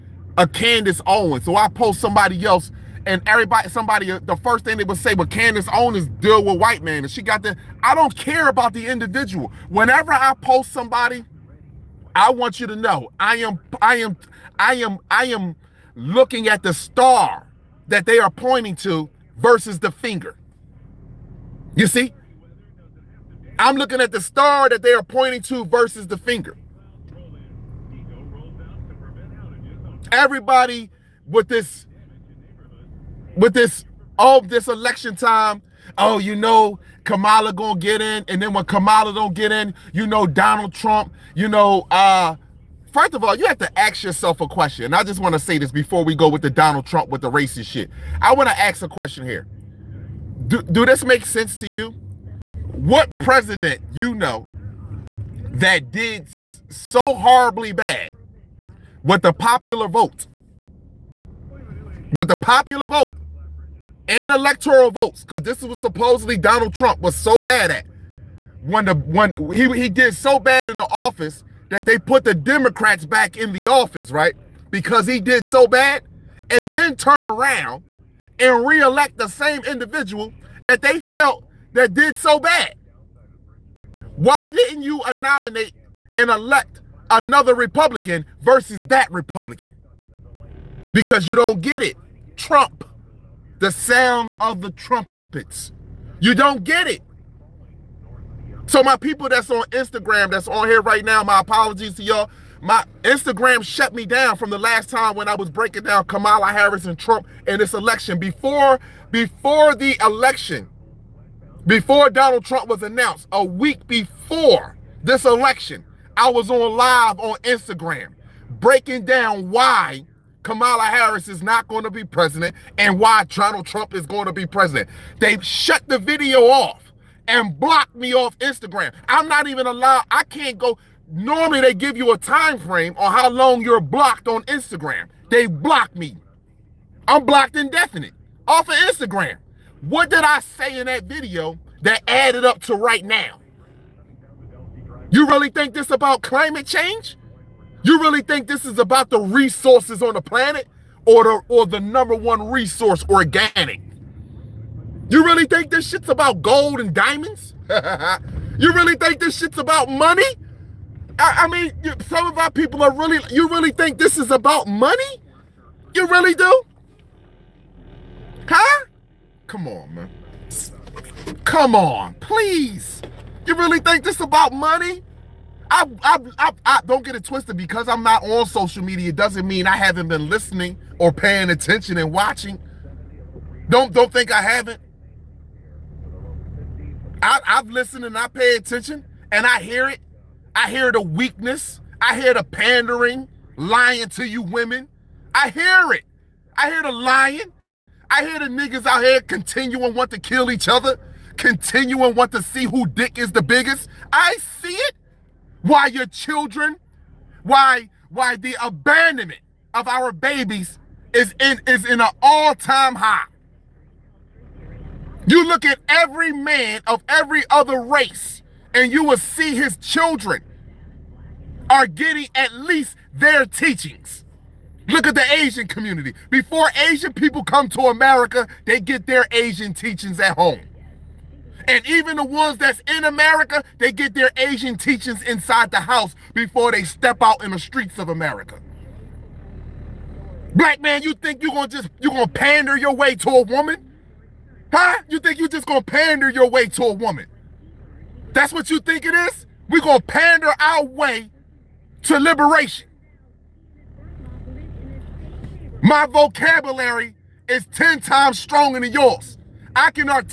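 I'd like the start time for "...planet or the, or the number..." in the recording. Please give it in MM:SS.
02:30.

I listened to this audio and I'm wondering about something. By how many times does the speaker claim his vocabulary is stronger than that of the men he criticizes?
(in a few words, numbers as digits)
10.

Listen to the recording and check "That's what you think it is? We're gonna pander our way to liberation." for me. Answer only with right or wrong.
right.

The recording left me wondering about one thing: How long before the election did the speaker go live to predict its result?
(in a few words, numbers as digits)
a week.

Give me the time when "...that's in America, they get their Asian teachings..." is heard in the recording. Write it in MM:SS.
03:52.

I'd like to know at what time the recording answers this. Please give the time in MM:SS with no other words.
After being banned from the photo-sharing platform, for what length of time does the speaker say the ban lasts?
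02:17.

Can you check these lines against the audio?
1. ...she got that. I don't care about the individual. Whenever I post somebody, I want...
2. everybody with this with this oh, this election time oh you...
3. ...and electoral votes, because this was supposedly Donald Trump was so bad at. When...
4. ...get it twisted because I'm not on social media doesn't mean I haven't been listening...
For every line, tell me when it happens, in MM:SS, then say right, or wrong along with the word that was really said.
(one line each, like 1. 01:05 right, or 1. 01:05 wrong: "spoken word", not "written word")
1. 00:07 right
2. 00:30 right
3. 01:04 right
4. 02:57 right.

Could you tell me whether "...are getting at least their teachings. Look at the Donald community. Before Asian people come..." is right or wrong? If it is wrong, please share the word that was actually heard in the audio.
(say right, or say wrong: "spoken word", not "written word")
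wrong: "Asian", not "Donald".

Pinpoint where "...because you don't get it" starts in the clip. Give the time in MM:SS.
01:30.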